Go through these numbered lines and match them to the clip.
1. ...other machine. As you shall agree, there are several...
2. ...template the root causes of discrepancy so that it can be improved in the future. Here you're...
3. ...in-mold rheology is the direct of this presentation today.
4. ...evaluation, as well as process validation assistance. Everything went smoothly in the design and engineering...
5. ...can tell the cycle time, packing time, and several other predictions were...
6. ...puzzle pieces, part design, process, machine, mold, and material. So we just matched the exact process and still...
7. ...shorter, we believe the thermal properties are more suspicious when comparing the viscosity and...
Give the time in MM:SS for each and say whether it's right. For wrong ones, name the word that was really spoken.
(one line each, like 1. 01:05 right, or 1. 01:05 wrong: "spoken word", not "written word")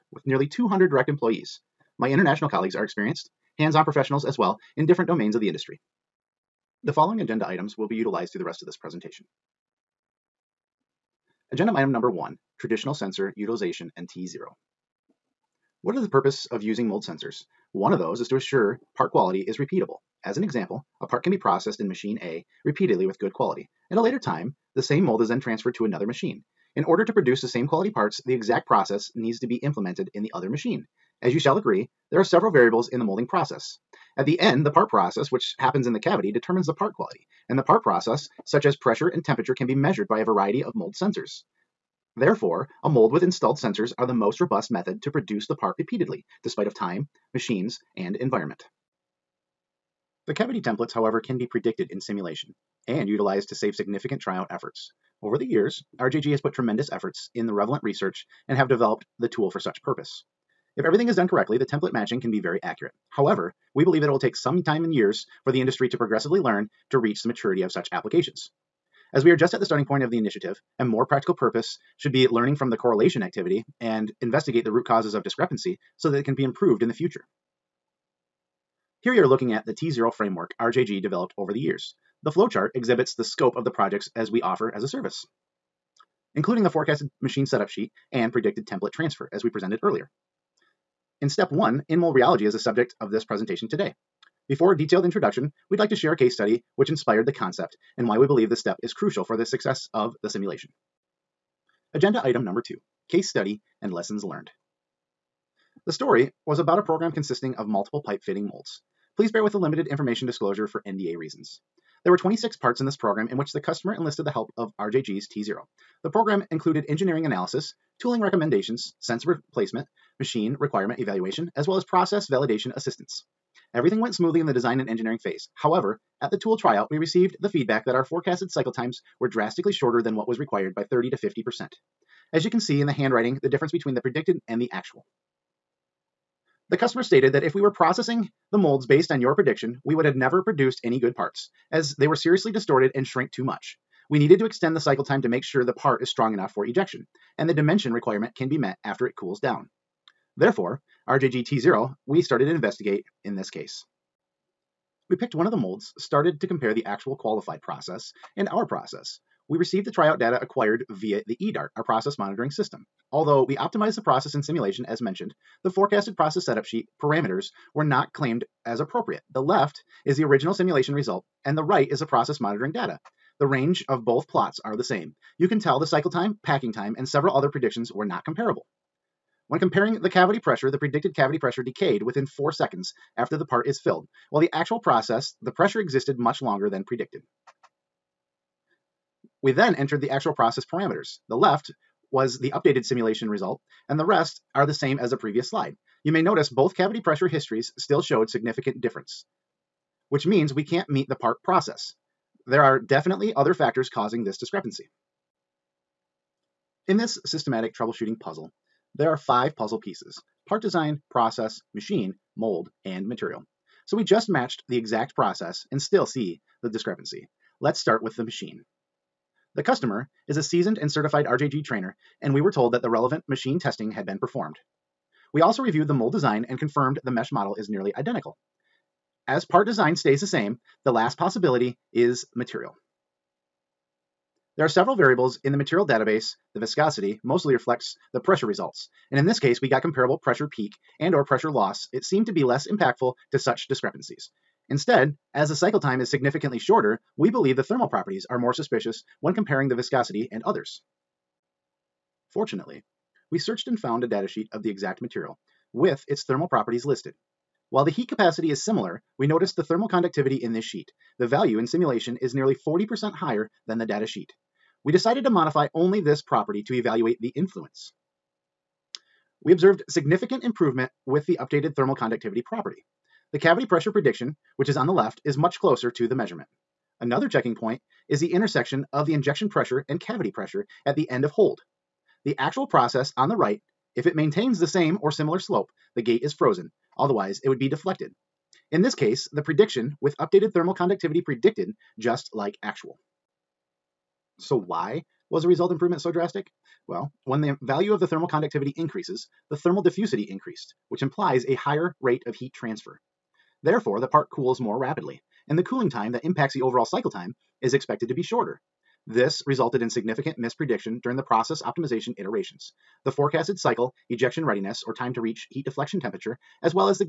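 1. 00:30 right
2. 01:14 wrong: "investigate", not "template"
3. 01:31 wrong: "subject", not "direct"
4. 02:00 right
5. 02:55 right
6. 03:29 right
7. 04:06 right.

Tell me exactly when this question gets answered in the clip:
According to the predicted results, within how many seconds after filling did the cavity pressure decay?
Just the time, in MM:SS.
03:02.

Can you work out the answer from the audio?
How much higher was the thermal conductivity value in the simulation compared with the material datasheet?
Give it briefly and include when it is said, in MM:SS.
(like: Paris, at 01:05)
nearly 40%, at 04:22.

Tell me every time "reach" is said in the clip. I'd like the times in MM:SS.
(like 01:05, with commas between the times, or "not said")
01:06, 05:15.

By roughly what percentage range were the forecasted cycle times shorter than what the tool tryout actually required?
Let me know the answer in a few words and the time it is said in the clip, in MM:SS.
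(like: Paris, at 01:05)
30 to 50%, at 02:10.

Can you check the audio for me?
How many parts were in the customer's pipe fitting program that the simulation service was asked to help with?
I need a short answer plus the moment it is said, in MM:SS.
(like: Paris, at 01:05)
26, at 01:52.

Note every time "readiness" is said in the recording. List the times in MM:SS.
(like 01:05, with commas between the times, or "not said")
05:14.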